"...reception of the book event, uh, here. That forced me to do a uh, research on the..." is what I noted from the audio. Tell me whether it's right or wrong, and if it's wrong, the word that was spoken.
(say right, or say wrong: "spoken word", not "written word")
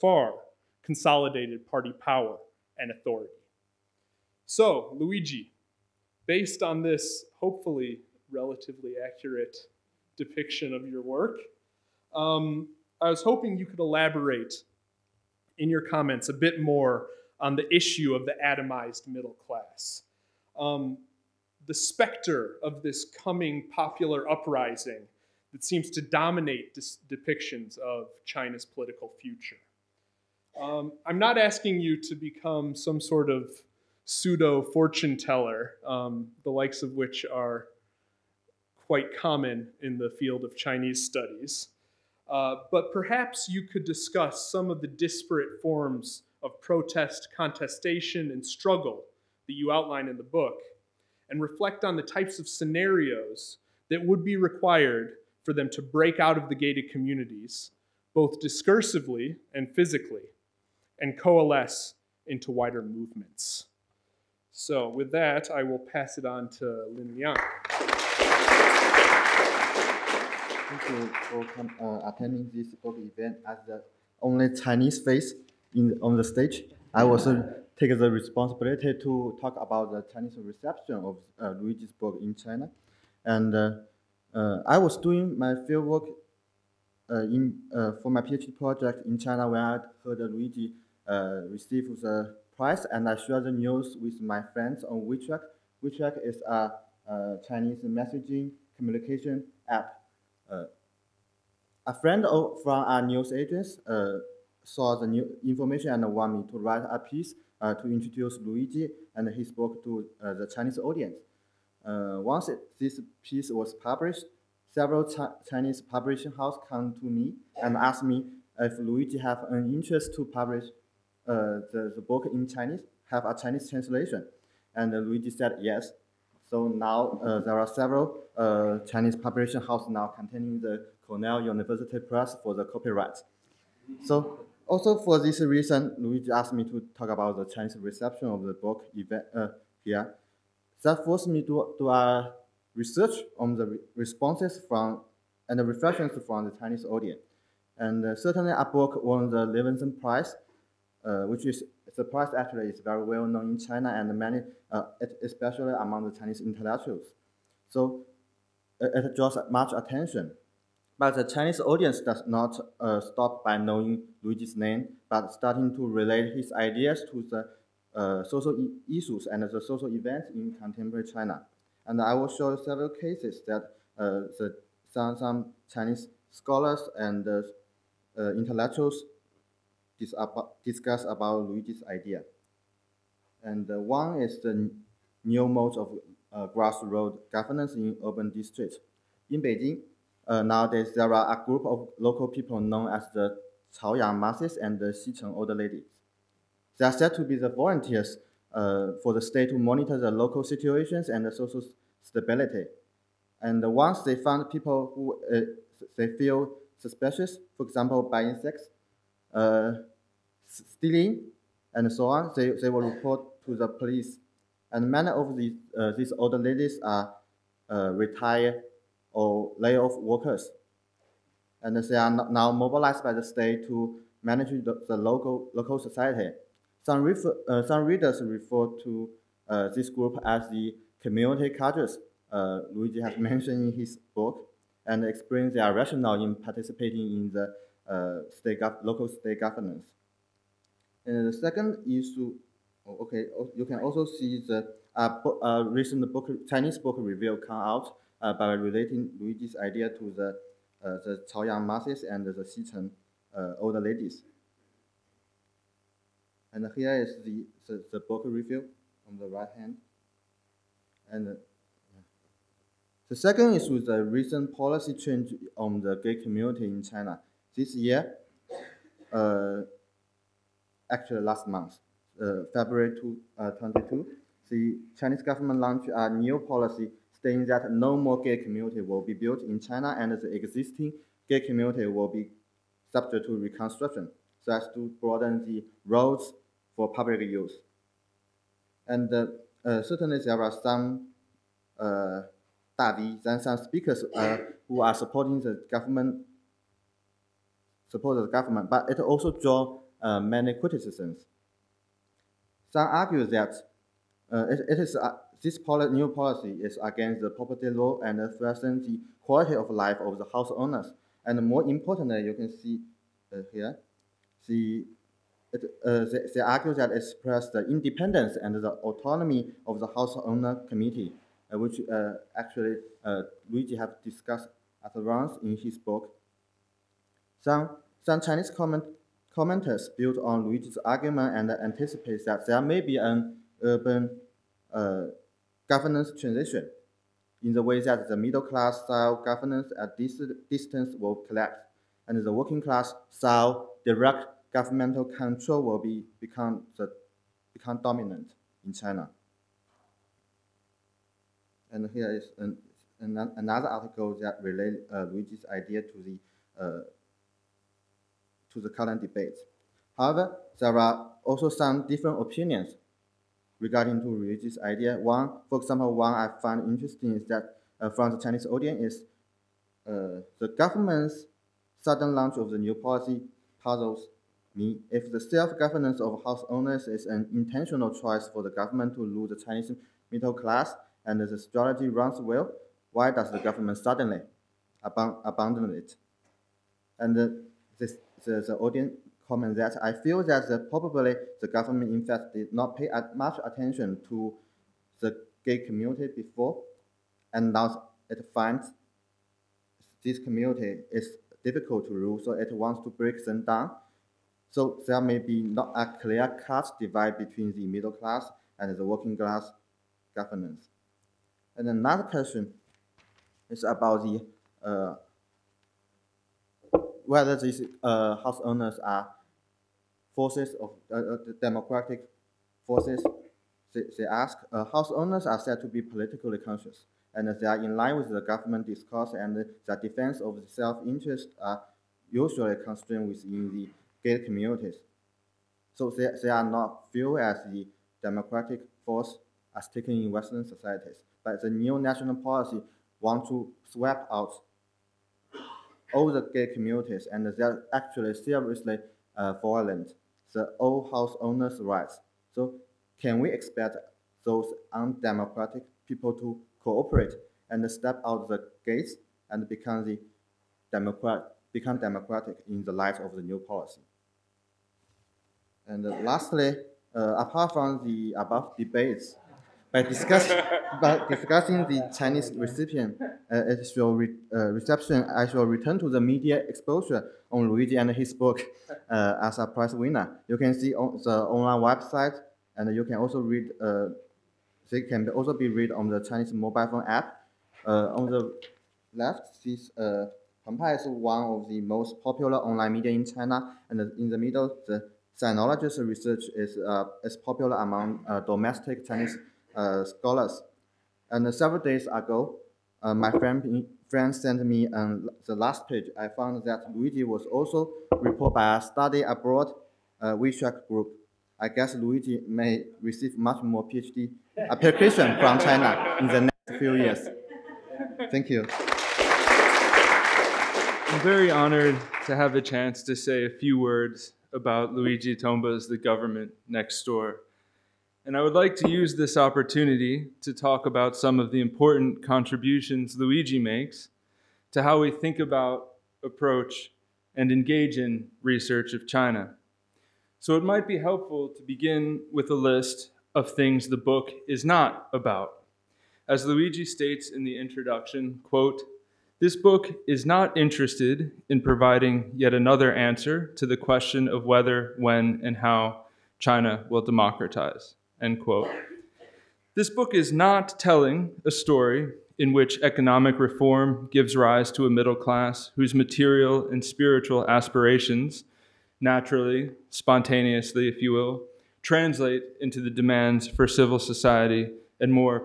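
right.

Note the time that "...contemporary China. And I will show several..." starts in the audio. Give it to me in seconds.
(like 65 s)
170 s.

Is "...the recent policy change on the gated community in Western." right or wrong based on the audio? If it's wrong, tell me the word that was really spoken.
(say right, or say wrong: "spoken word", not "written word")
wrong: "China", not "Western".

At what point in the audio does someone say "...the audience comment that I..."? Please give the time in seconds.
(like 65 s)
388 s.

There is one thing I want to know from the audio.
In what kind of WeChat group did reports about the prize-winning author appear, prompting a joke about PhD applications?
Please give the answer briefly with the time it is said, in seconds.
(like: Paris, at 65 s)
study abroad, at 508 s.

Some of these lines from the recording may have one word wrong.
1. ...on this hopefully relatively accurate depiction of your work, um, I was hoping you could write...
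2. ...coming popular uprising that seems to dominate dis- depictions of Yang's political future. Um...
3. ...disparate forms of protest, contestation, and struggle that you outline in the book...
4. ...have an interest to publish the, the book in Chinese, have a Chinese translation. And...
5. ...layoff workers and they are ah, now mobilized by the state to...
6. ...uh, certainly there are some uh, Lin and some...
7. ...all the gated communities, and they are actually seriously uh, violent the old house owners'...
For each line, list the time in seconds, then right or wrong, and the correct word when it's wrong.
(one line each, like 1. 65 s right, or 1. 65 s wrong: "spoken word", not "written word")
1. 6 s wrong: "elaborate", not "write"
2. 23 s wrong: "China", not "Yang"
3. 44 s right
4. 119 s right
5. 219 s right
6. 289 s wrong: "Davis", not "Lin"
7. 445 s right.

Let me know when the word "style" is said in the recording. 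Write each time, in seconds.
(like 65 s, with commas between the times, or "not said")
338 s, 343 s.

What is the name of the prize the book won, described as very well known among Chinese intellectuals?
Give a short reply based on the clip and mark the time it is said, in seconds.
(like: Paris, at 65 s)
Levenson Prize, at 149 s.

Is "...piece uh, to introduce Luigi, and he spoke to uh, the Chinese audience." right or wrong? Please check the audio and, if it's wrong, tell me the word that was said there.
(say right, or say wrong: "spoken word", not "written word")
right.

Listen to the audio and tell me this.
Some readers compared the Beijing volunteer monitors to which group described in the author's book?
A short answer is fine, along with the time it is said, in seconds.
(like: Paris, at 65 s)
community cadres, at 231 s.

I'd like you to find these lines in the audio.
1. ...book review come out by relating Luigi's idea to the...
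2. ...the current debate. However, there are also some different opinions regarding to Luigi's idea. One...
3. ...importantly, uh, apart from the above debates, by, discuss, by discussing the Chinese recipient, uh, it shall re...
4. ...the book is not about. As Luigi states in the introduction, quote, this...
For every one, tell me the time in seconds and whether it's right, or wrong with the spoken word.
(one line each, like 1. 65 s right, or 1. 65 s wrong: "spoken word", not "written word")
1. 246 s right
2. 358 s right
3. 466 s wrong: "lastly", not "importantly"
4. 543 s right.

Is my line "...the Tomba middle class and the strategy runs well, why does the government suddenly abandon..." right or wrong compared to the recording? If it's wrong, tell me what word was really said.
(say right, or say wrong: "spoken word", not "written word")
wrong: "Chinese", not "Tomba".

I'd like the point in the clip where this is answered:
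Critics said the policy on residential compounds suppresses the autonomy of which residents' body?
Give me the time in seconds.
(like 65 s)
319 s.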